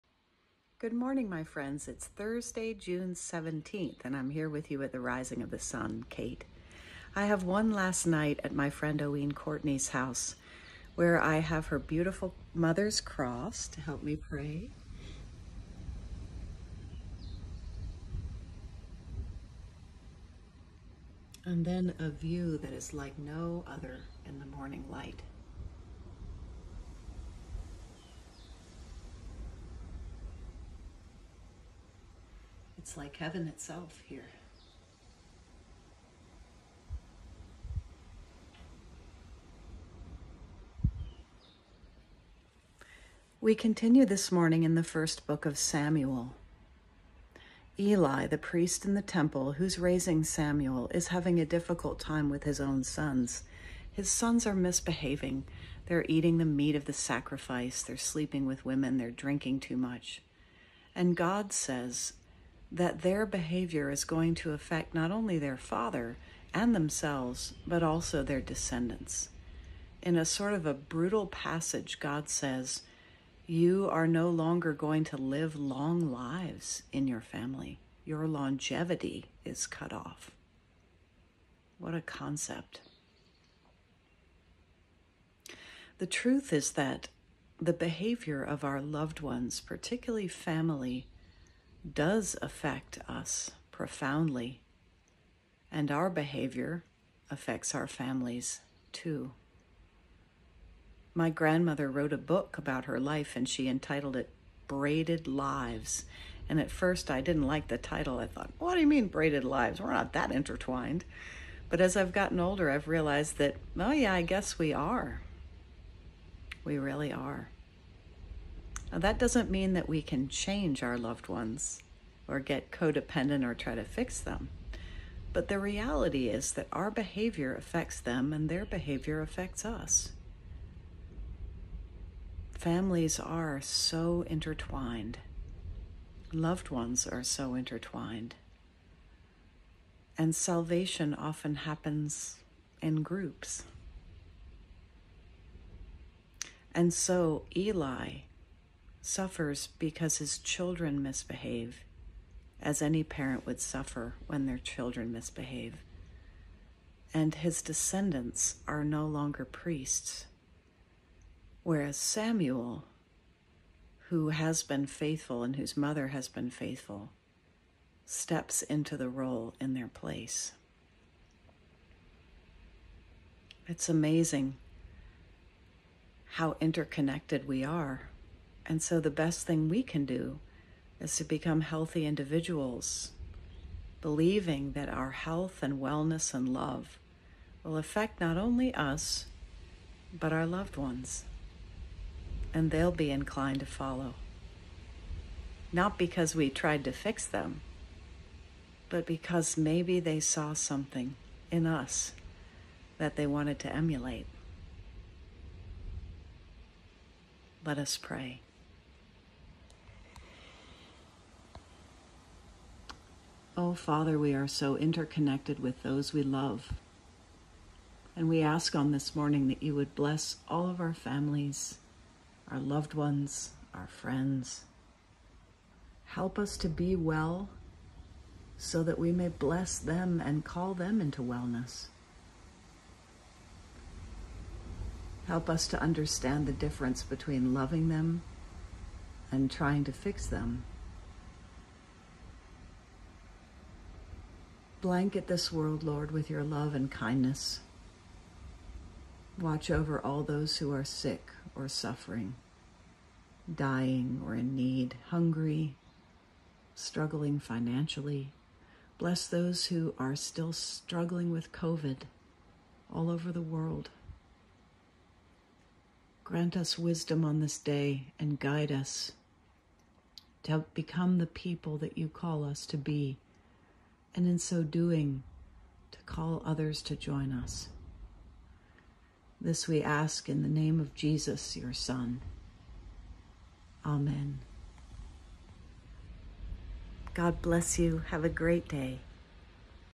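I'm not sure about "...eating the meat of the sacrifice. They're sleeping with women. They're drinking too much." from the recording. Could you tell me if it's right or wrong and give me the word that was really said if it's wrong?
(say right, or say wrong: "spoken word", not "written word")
right.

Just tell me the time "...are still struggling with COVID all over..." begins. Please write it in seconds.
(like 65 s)
259 s.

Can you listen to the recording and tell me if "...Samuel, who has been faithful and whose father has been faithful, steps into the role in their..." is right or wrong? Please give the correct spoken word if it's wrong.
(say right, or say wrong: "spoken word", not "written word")
wrong: "mother", not "father".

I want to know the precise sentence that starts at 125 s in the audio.
But the reality is that our behavior affects them and their behavior affects us.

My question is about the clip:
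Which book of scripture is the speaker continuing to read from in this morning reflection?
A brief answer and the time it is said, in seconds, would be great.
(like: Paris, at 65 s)
First book of Samuel, at 44 s.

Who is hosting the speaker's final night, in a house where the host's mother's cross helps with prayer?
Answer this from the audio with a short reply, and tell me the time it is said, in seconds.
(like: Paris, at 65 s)
Owen Courtney, at 8 s.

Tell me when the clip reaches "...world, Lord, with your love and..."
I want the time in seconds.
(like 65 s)
245 s.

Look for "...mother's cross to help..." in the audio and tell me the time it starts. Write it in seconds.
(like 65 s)
12 s.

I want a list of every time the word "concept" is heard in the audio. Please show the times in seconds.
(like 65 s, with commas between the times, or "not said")
82 s.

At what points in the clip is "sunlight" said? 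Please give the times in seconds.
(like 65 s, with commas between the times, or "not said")
not said.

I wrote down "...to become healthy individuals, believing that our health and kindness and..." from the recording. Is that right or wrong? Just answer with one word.
wrong.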